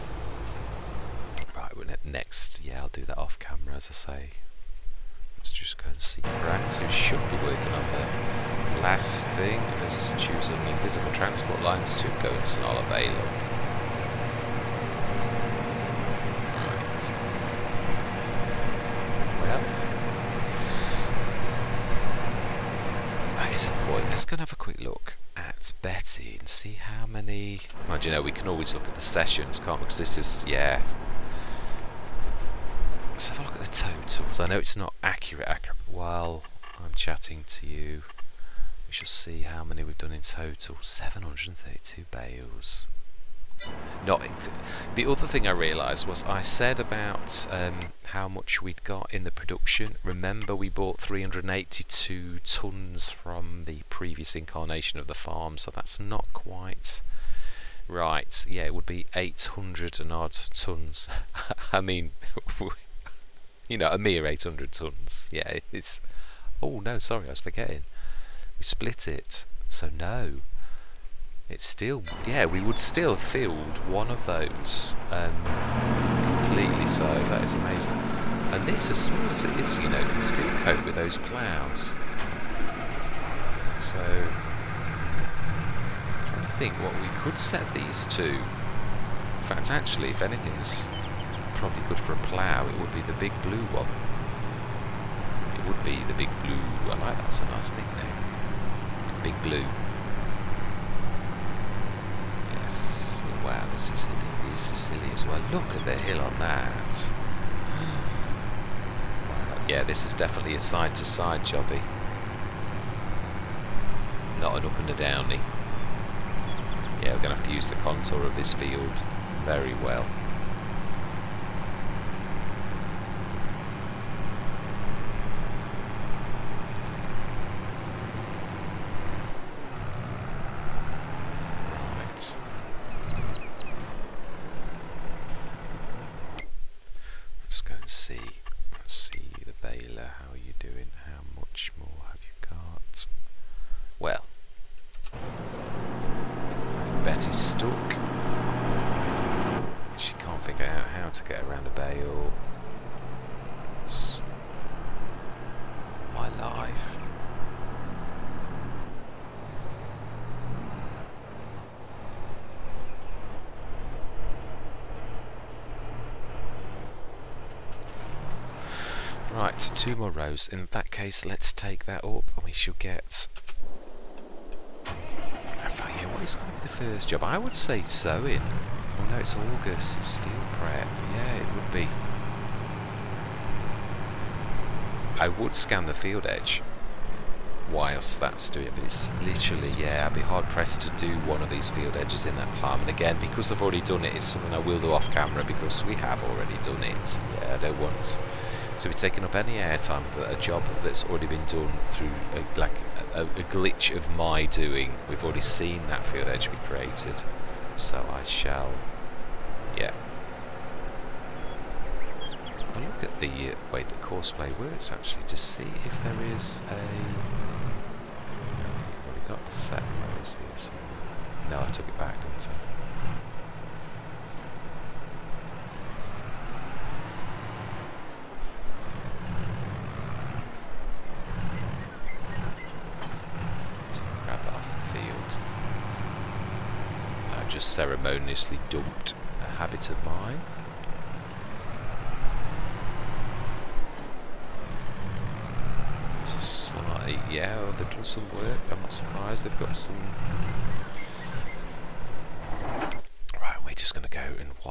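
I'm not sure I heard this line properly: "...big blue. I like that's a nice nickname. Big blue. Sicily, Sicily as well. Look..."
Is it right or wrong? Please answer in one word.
right.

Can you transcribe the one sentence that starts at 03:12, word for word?
And again, because I've already done it, it's something I will do off camera because we have already done it.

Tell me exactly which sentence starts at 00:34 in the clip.
I know it's not accurate, accurate.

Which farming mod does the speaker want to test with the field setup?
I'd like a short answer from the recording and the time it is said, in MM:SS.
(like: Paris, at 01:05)
Courseplay, at 03:34.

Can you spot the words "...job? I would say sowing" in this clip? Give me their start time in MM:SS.
02:57.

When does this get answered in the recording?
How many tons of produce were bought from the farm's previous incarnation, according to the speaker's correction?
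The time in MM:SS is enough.
00:50.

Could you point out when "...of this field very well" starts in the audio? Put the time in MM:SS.
01:58.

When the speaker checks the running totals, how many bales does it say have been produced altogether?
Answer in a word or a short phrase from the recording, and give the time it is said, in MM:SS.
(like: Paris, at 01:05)
732, at 00:40.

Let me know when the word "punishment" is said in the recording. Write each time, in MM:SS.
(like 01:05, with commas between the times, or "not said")
not said.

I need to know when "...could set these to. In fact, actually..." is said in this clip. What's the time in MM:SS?
01:27.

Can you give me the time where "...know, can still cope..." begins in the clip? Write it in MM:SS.
01:19.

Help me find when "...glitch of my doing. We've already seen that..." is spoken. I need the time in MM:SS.
03:23.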